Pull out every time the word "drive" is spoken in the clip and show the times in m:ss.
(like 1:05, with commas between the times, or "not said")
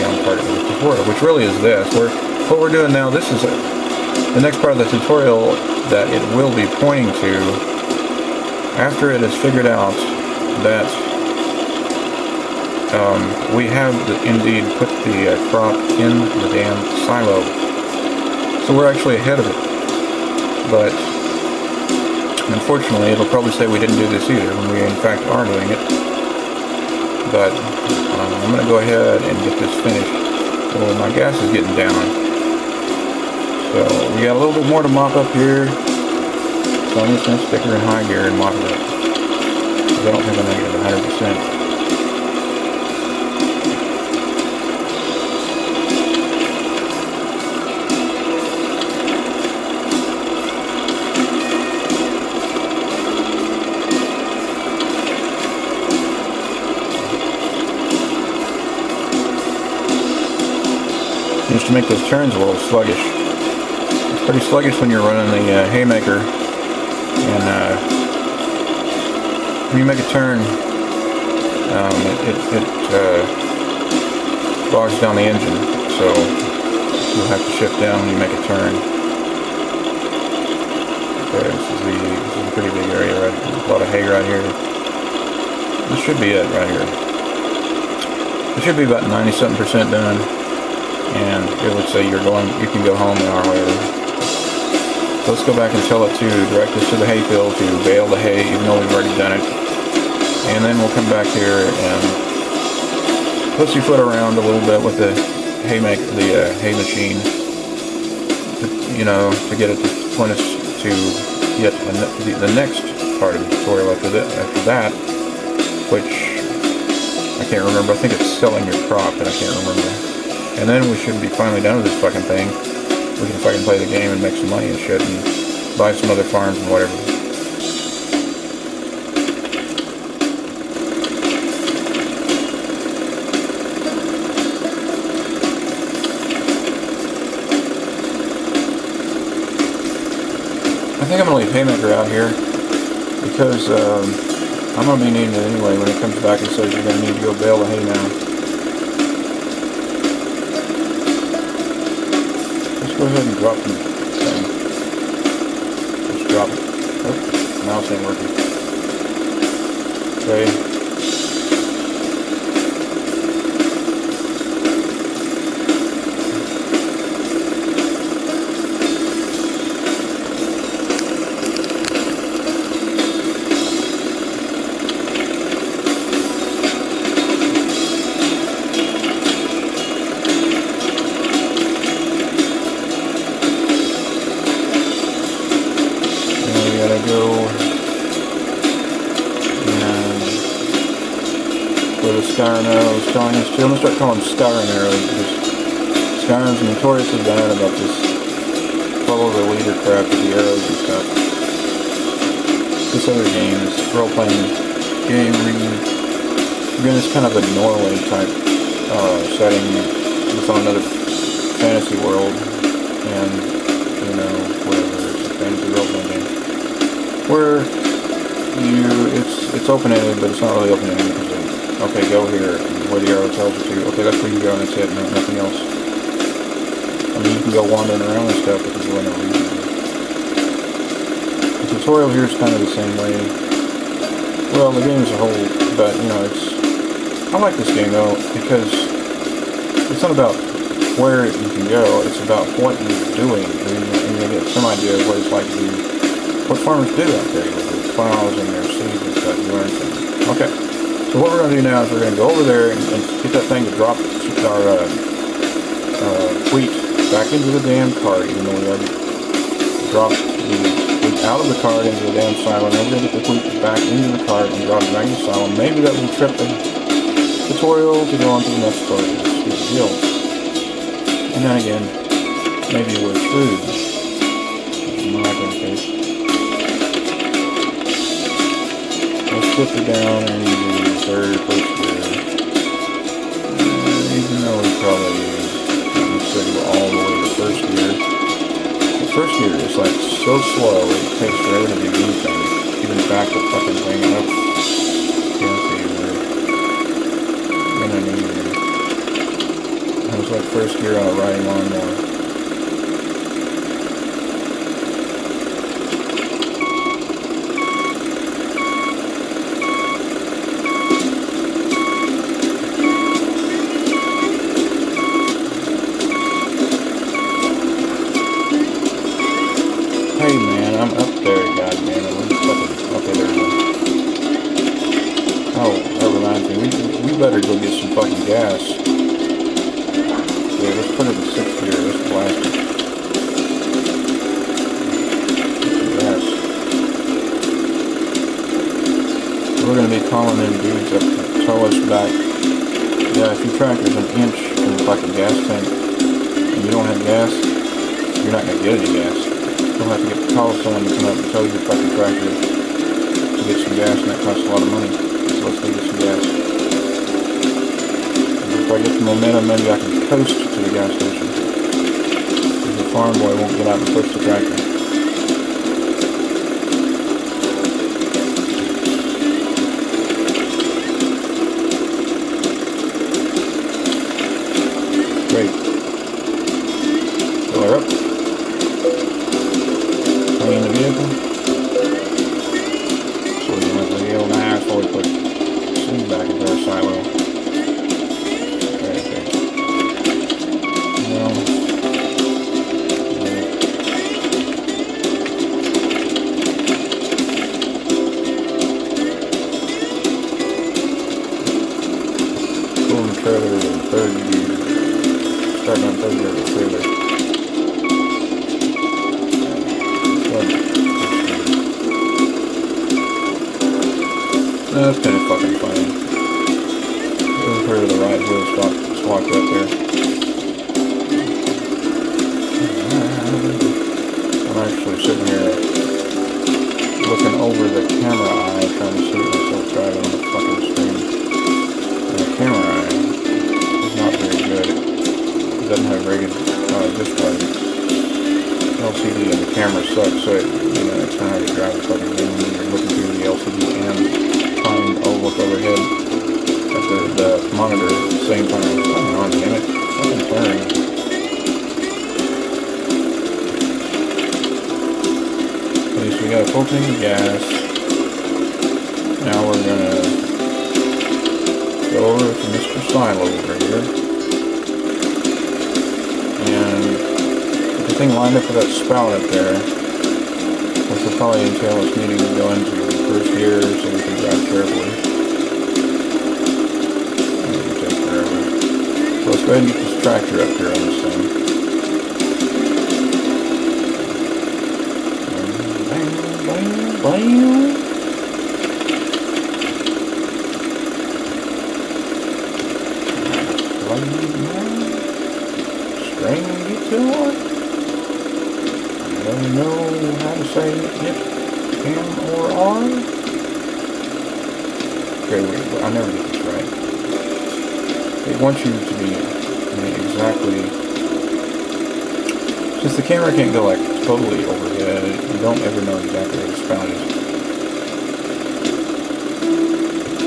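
7:21, 7:54.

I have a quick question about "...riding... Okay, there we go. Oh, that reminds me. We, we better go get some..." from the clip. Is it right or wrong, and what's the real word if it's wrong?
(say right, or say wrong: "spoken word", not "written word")
wrong: "fucking", not "riding".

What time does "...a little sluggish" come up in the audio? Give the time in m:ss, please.
1:02.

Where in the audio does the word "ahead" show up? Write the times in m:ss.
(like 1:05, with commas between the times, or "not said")
0:19, 0:28, 2:33, 7:59.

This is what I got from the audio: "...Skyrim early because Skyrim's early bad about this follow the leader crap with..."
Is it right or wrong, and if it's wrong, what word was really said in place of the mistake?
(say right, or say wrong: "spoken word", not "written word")
wrong: "notoriously", not "early".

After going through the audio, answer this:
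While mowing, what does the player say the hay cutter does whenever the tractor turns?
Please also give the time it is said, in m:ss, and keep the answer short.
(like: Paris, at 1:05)
Bogs down the engine, at 1:14.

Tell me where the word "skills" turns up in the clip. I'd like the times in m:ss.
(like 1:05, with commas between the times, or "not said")
not said.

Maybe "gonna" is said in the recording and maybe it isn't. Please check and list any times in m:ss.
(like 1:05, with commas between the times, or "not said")
5:39, 5:48, 7:39.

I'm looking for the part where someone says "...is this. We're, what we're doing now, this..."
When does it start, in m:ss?
0:01.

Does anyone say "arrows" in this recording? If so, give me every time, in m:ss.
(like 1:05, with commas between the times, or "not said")
3:20, 3:43.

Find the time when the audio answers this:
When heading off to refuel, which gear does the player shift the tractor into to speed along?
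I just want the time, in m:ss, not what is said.
5:31.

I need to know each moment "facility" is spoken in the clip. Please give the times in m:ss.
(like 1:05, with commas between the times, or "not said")
not said.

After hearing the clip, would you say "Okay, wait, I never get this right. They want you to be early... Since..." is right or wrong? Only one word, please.
wrong.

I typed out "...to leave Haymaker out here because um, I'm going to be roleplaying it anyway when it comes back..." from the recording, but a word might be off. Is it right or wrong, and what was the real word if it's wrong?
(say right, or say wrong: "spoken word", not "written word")
wrong: "needing", not "roleplaying".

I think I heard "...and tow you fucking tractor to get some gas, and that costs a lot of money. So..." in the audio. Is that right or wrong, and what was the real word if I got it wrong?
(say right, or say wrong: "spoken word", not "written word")
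right.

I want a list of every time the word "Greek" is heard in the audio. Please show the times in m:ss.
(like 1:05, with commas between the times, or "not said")
not said.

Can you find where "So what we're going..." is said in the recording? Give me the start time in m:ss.
4:11.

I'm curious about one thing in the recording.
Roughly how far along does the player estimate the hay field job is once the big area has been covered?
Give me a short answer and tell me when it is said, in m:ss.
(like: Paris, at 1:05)
90 something percent, at 1:29.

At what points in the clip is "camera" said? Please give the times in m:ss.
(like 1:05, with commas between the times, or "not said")
7:19, 8:33.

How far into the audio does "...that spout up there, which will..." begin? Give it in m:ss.
7:48.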